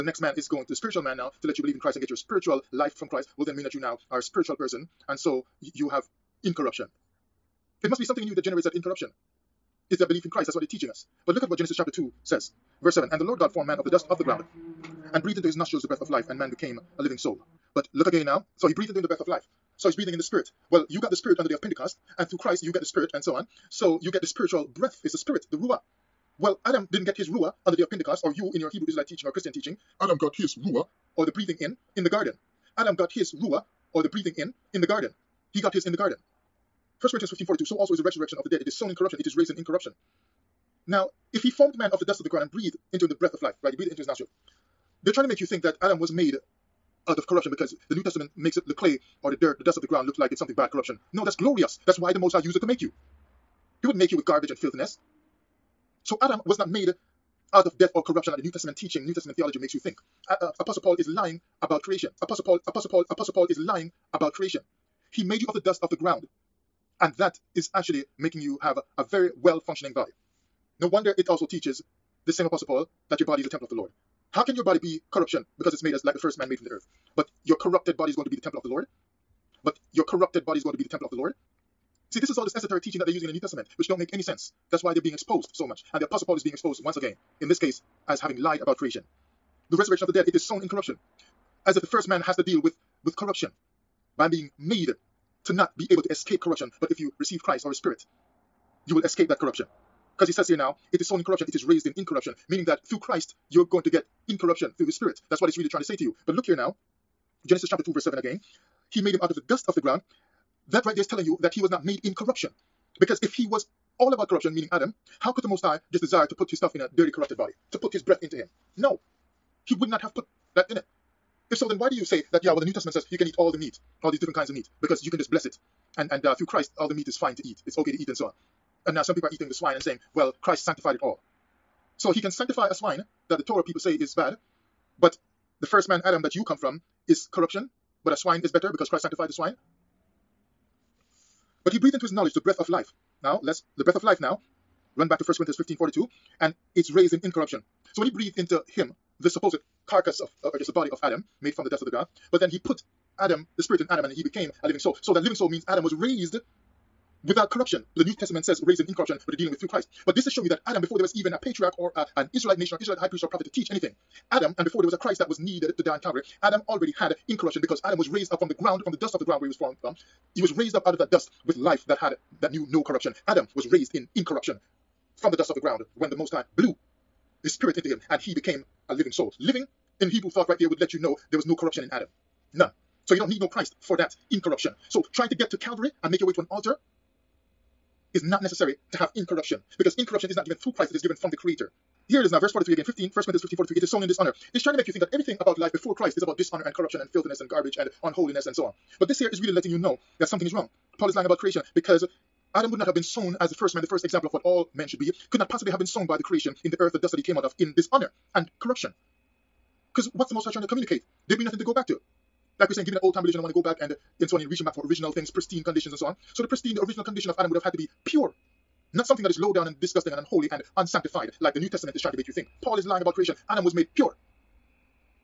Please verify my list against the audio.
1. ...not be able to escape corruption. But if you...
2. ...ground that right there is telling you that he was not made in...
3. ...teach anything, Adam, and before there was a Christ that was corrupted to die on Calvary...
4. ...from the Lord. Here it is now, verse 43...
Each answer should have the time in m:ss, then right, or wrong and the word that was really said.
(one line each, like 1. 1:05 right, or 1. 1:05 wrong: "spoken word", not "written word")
1. 1:35 right
2. 1:49 right
3. 2:43 wrong: "needed", not "corrupted"
4. 3:11 wrong: "Creator", not "Lord".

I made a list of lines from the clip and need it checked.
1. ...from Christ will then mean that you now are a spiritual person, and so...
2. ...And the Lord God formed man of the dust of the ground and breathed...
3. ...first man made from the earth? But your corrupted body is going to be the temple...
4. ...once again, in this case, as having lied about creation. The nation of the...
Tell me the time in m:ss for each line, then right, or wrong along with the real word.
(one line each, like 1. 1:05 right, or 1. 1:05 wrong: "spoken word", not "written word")
1. 0:02 right
2. 0:13 right
3. 1:16 right
4. 1:26 wrong: "resurrection", not "nation".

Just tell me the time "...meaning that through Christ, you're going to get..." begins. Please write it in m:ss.
1:42.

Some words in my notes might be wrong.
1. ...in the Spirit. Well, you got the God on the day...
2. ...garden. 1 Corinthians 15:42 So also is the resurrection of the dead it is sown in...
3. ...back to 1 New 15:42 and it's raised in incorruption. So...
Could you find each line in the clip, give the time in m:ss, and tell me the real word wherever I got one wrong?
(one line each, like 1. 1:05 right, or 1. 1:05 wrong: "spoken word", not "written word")
1. 0:20 wrong: "Spirit", not "God"
2. 0:35 right
3. 2:25 wrong: "Corinthians", not "New".